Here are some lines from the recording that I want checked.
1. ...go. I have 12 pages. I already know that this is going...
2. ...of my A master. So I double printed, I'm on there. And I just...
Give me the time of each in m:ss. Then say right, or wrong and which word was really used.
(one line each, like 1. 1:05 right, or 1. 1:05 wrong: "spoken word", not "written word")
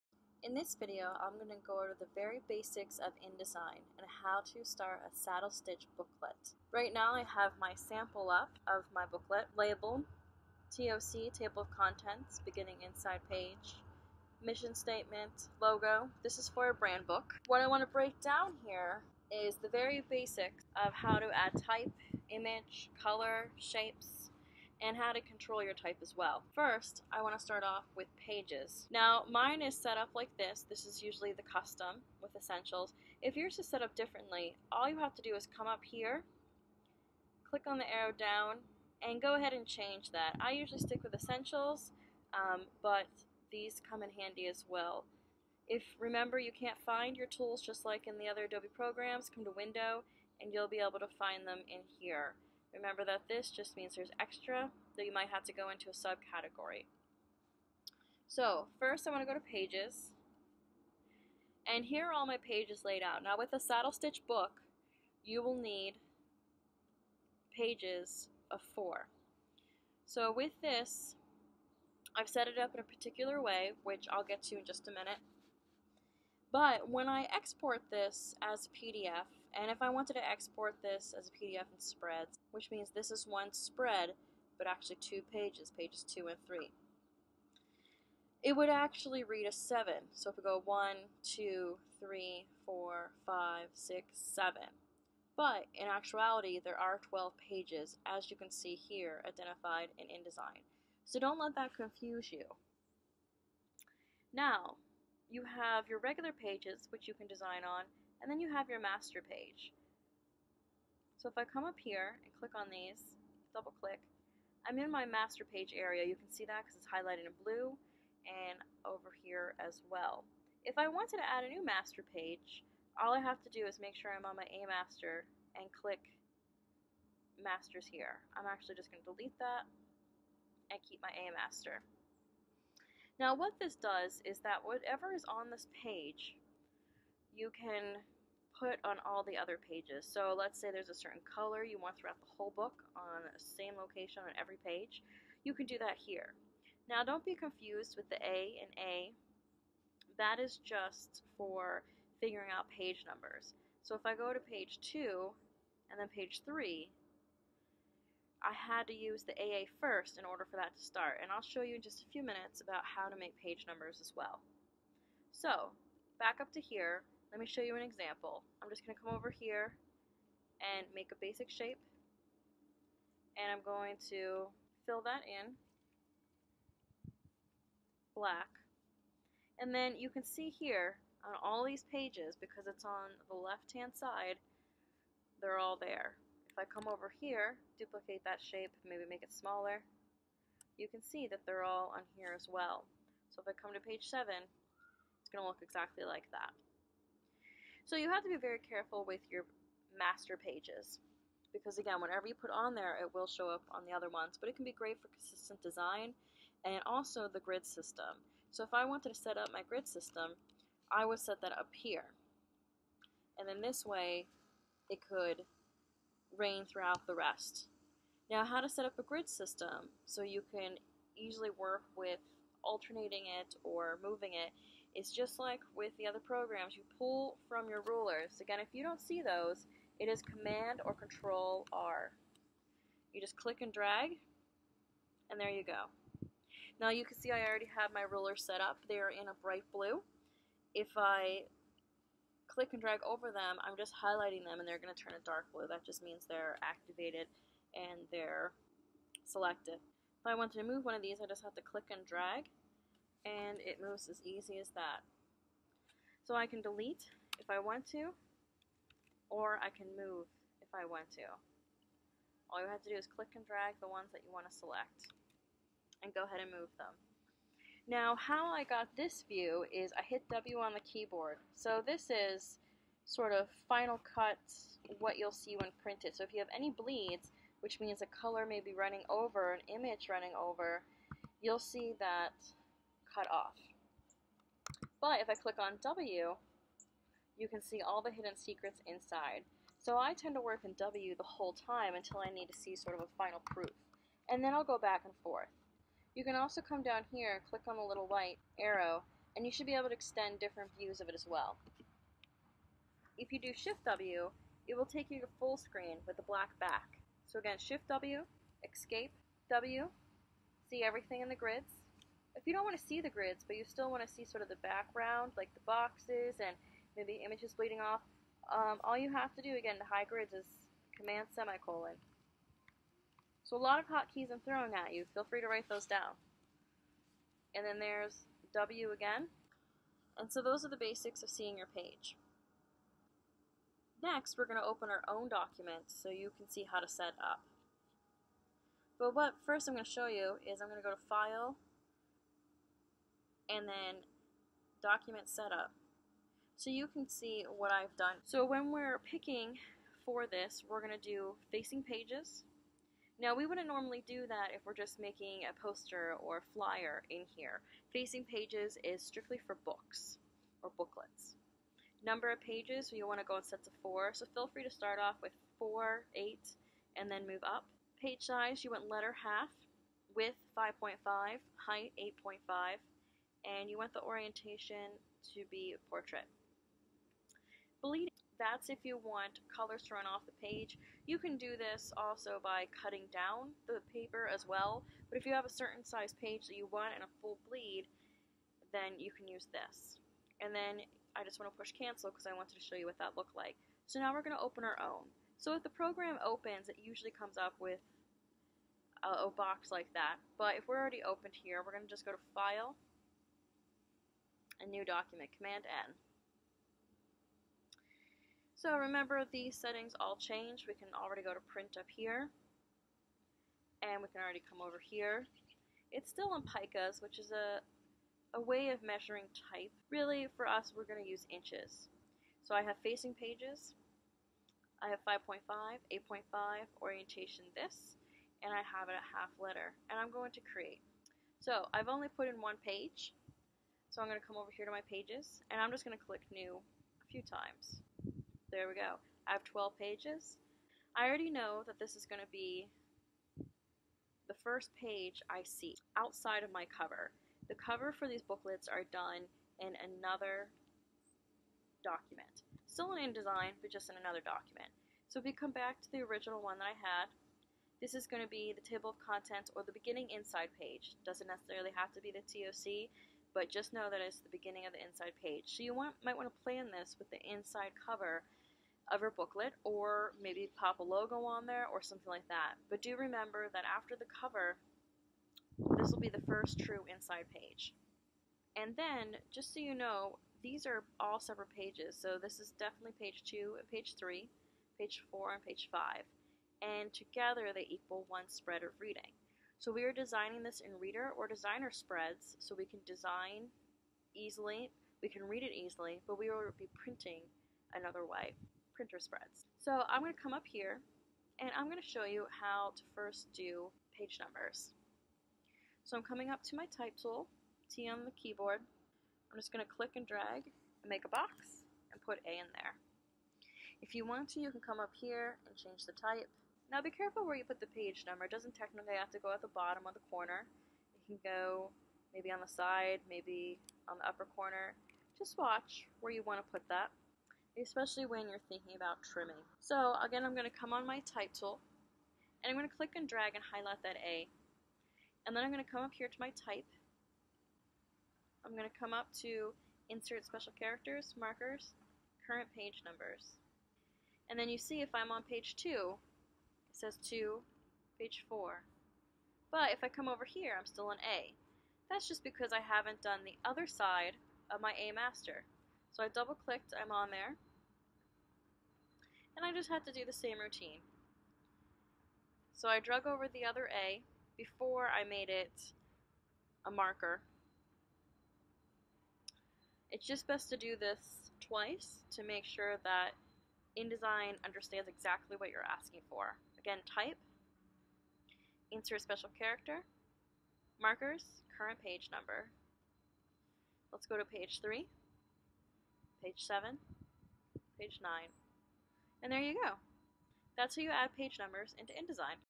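1. 7:18 right
2. 9:14 wrong: "clicked", not "printed".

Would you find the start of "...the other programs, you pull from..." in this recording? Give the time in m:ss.
3:45.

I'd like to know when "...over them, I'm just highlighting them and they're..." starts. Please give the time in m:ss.
4:03.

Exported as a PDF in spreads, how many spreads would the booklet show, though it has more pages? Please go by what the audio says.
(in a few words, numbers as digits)
7.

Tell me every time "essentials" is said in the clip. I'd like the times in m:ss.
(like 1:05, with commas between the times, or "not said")
0:32, 0:41.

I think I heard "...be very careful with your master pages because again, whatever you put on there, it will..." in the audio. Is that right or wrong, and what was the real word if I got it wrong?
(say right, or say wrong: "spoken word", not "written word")
right.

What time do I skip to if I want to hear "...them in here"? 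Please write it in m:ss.
0:51.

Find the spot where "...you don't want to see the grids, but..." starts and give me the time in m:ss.
5:12.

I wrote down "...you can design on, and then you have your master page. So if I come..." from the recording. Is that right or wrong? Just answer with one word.
right.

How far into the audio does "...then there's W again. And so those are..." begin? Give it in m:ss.
5:27.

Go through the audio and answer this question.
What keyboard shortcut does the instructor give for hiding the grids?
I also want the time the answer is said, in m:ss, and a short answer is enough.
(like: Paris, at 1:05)
Command semicolon, at 5:20.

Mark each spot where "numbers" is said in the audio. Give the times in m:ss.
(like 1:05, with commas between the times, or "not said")
2:33, 2:43, 6:02, 8:24, 8:38, 9:02, 9:42, 9:51.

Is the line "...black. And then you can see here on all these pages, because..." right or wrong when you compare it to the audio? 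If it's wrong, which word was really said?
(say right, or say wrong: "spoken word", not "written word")
right.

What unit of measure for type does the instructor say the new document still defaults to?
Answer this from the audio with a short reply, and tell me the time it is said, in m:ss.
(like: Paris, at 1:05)
Picas, at 6:56.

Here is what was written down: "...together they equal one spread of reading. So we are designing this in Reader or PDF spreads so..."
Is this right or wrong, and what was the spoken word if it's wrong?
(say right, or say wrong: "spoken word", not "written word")
wrong: "Designer", not "PDF".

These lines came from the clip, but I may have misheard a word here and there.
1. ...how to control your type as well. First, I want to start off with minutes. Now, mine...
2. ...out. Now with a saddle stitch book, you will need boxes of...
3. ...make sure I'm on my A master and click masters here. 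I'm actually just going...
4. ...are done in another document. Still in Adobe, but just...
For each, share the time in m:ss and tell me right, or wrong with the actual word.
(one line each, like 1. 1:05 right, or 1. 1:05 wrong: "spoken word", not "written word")
1. 0:24 wrong: "pages", not "minutes"
2. 1:03 wrong: "pages", not "boxes"
3. 2:03 right
4. 7:28 wrong: "InDesign", not "Adobe".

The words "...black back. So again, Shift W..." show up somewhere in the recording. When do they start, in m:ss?
5:06.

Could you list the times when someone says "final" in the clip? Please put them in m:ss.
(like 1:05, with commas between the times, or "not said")
4:33, 4:53.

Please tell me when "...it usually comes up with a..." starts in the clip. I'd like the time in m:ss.
6:36.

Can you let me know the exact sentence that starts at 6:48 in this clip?
So remember these settings all change.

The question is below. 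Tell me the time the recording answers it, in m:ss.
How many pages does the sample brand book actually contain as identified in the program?
1:36.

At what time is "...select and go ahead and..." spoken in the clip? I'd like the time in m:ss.
4:24.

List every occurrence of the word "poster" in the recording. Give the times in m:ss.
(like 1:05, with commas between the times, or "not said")
5:55.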